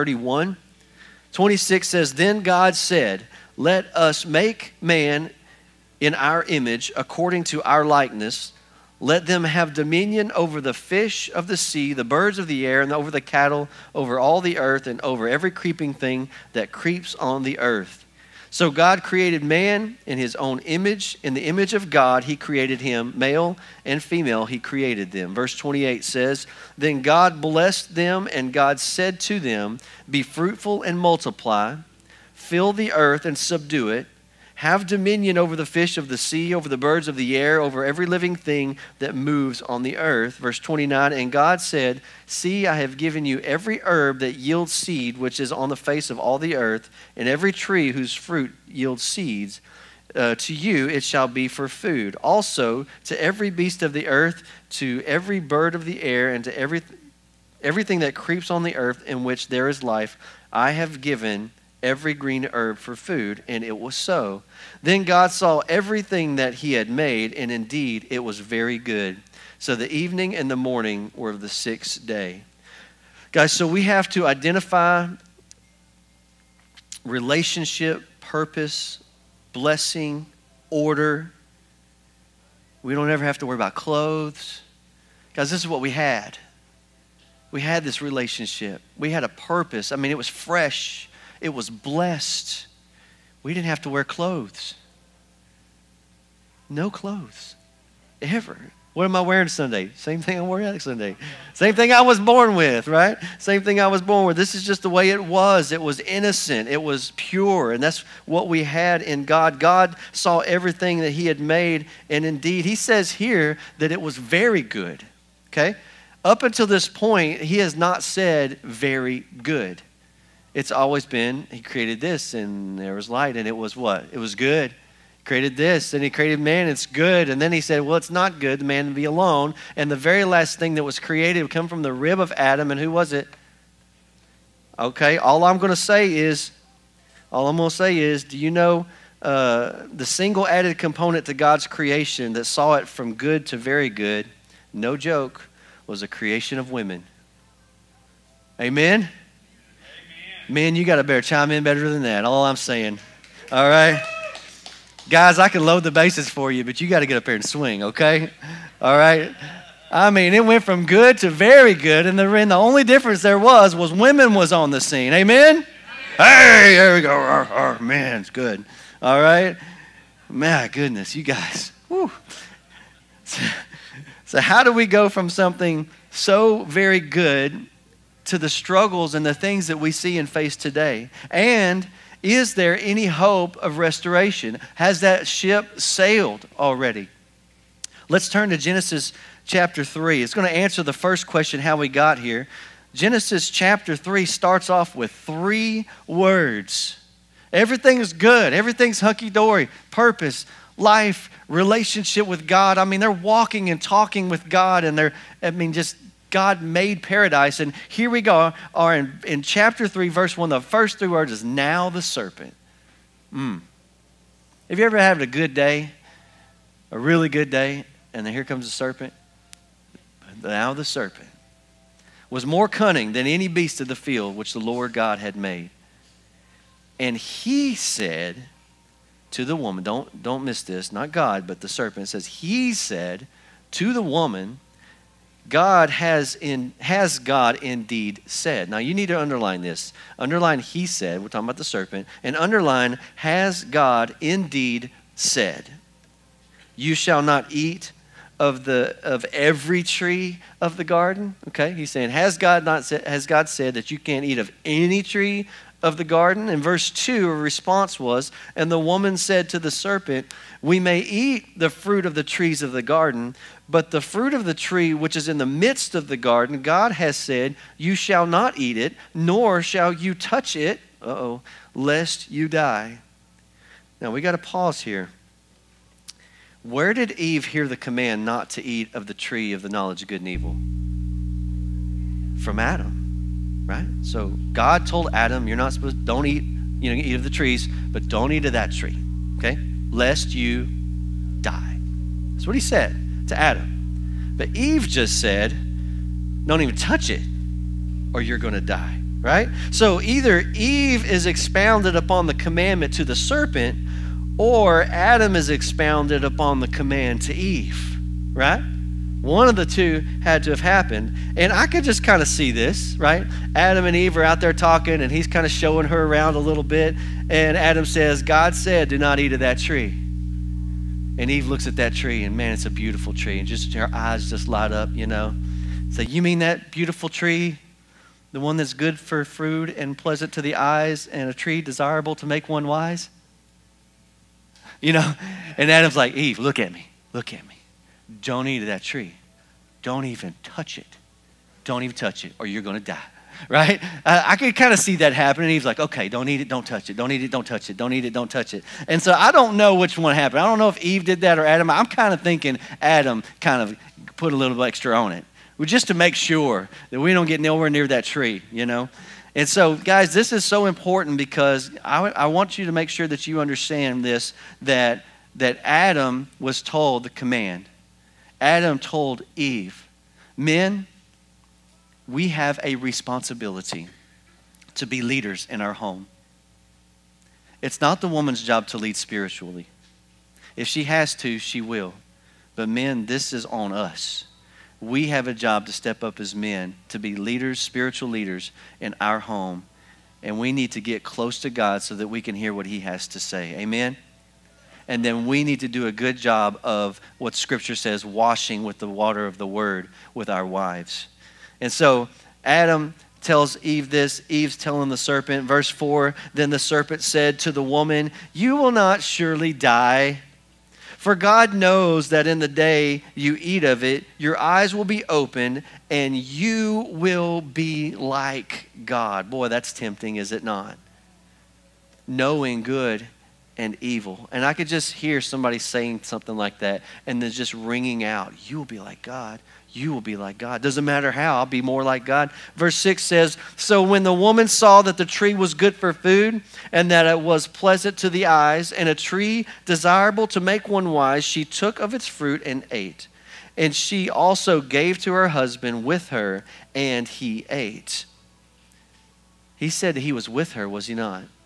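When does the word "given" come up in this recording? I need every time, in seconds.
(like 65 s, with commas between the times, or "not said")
42 s, 61 s.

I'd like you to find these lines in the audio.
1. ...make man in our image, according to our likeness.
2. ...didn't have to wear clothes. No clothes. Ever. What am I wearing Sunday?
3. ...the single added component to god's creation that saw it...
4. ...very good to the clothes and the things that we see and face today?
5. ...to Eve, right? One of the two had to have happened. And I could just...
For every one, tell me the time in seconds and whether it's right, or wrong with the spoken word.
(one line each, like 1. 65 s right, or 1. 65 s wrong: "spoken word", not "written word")
1. 4 s right
2. 93 s right
3. 139 s right
4. 176 s wrong: "struggles", not "clothes"
5. 307 s right.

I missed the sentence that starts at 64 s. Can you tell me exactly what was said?
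Then God saw everything that he had made, and indeed it was very good.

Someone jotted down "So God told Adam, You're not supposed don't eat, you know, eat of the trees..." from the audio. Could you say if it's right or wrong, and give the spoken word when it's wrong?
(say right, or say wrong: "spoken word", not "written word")
right.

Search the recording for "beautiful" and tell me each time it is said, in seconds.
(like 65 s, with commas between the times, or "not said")
322 s, 326 s.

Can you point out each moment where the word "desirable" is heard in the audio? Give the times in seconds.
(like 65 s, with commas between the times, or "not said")
331 s, 439 s.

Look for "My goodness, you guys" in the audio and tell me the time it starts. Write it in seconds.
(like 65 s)
170 s.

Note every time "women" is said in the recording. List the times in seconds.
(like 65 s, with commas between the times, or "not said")
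146 s, 163 s.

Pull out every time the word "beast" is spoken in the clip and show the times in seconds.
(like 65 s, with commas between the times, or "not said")
53 s, 223 s.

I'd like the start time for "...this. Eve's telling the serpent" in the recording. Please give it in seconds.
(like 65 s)
403 s.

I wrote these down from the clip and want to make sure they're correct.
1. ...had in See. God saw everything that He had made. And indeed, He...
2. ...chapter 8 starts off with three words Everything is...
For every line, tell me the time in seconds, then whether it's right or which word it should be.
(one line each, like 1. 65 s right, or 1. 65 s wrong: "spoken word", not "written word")
1. 108 s wrong: "God", not "See"
2. 193 s wrong: "3", not "8".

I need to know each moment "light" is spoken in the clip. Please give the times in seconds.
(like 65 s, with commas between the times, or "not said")
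123 s, 324 s.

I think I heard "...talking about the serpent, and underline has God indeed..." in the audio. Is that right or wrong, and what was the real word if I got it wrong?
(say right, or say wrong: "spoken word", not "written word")
right.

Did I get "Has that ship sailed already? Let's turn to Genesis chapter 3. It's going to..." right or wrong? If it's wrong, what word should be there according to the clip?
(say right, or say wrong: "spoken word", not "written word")
right.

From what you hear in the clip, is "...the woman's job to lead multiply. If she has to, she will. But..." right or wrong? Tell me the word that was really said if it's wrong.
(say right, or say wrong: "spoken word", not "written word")
wrong: "spiritually", not "multiply".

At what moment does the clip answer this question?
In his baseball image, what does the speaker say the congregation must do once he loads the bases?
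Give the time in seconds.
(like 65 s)
157 s.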